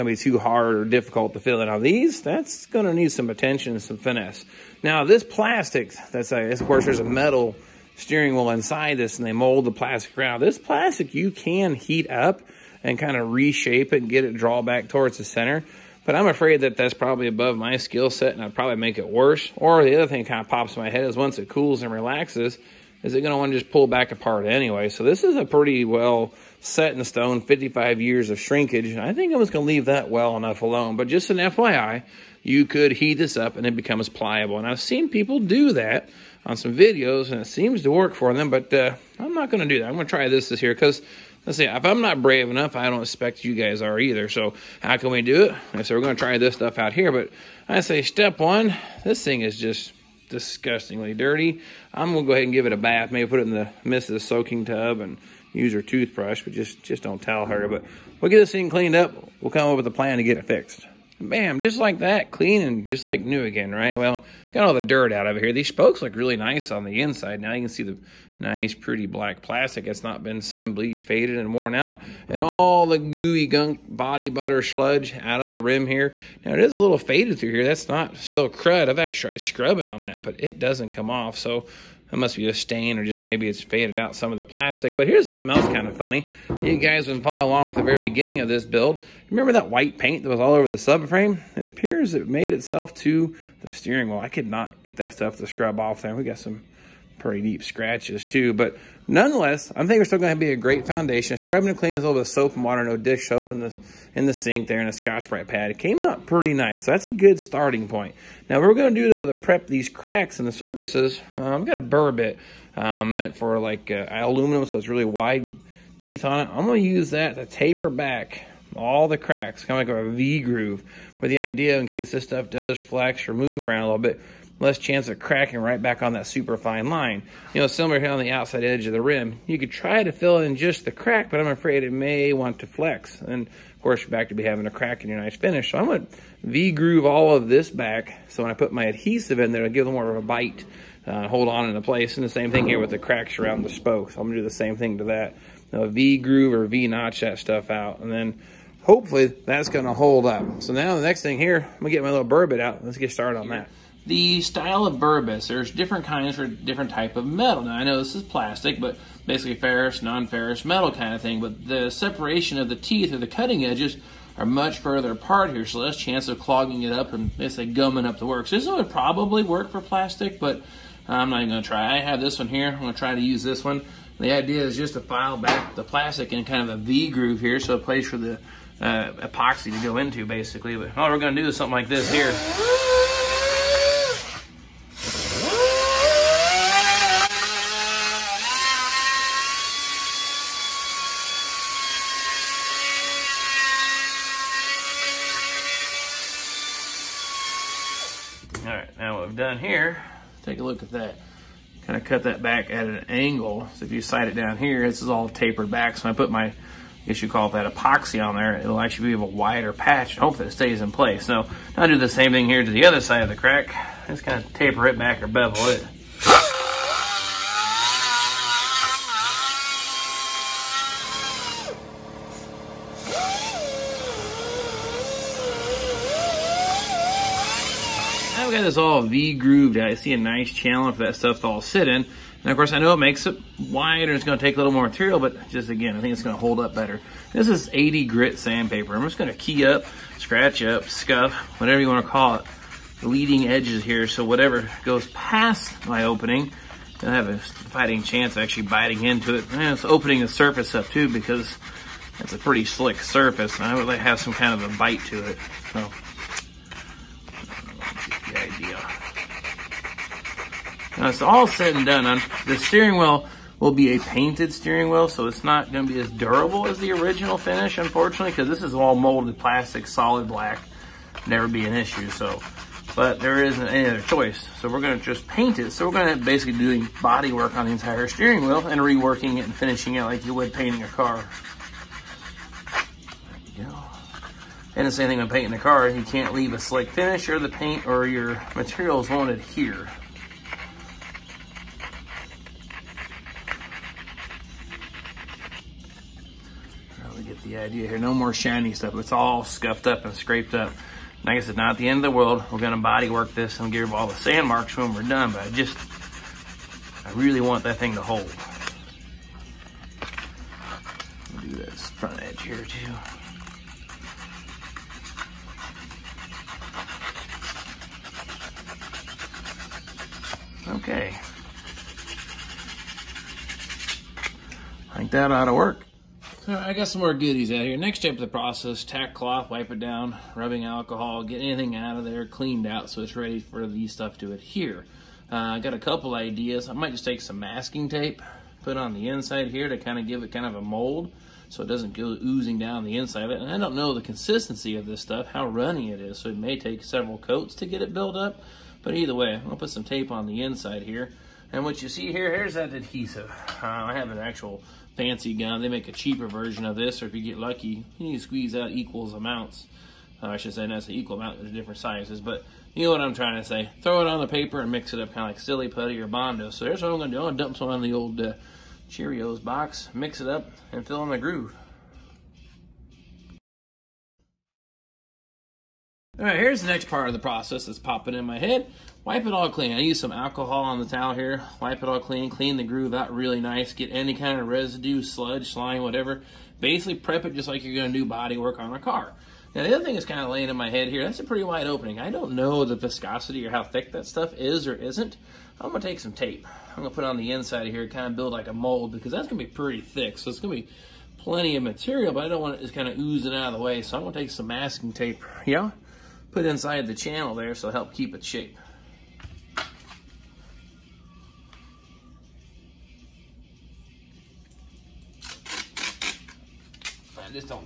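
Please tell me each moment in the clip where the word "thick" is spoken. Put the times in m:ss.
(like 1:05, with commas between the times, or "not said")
6:33, 6:39.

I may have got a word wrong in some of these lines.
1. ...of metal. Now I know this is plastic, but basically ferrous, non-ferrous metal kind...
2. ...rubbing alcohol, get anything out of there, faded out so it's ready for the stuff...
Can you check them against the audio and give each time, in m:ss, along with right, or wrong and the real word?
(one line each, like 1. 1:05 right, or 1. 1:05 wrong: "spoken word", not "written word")
1. 2:37 right
2. 5:30 wrong: "cleaned", not "faded".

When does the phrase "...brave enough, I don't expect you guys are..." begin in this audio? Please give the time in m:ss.
0:42.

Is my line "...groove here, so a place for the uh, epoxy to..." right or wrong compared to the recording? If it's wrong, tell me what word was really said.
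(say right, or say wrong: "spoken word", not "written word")
right.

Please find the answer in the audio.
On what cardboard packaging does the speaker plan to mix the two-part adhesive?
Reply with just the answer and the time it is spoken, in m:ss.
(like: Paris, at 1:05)
Cheerios box, at 6:08.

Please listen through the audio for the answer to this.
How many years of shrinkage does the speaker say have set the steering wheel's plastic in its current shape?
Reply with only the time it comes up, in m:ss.
0:27.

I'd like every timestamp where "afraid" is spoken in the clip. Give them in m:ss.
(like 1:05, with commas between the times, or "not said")
0:16, 2:11.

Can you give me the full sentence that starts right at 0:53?
Maybe put it in the midst of the soaking tub and use her toothbrush, but just, just don't tell her.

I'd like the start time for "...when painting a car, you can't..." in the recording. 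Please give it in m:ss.
4:45.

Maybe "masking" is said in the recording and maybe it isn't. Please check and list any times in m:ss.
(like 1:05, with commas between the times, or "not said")
5:37, 6:44.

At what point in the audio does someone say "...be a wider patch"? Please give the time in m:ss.
3:29.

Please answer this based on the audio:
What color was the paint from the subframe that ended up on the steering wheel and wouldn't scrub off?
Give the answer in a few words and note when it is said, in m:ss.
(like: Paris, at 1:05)
White, at 1:29.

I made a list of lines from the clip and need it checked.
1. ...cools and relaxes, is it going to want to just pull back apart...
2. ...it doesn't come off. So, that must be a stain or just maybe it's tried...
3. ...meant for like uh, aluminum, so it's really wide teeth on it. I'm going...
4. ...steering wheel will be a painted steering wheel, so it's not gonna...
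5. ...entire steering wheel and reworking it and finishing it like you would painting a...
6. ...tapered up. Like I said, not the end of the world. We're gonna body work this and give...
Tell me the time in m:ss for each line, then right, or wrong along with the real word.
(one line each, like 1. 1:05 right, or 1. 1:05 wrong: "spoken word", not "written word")
1. 0:21 right
2. 1:20 wrong: "faded", not "tried"
3. 1:53 right
4. 4:22 right
5. 4:37 right
6. 5:00 wrong: "scraped", not "tapered".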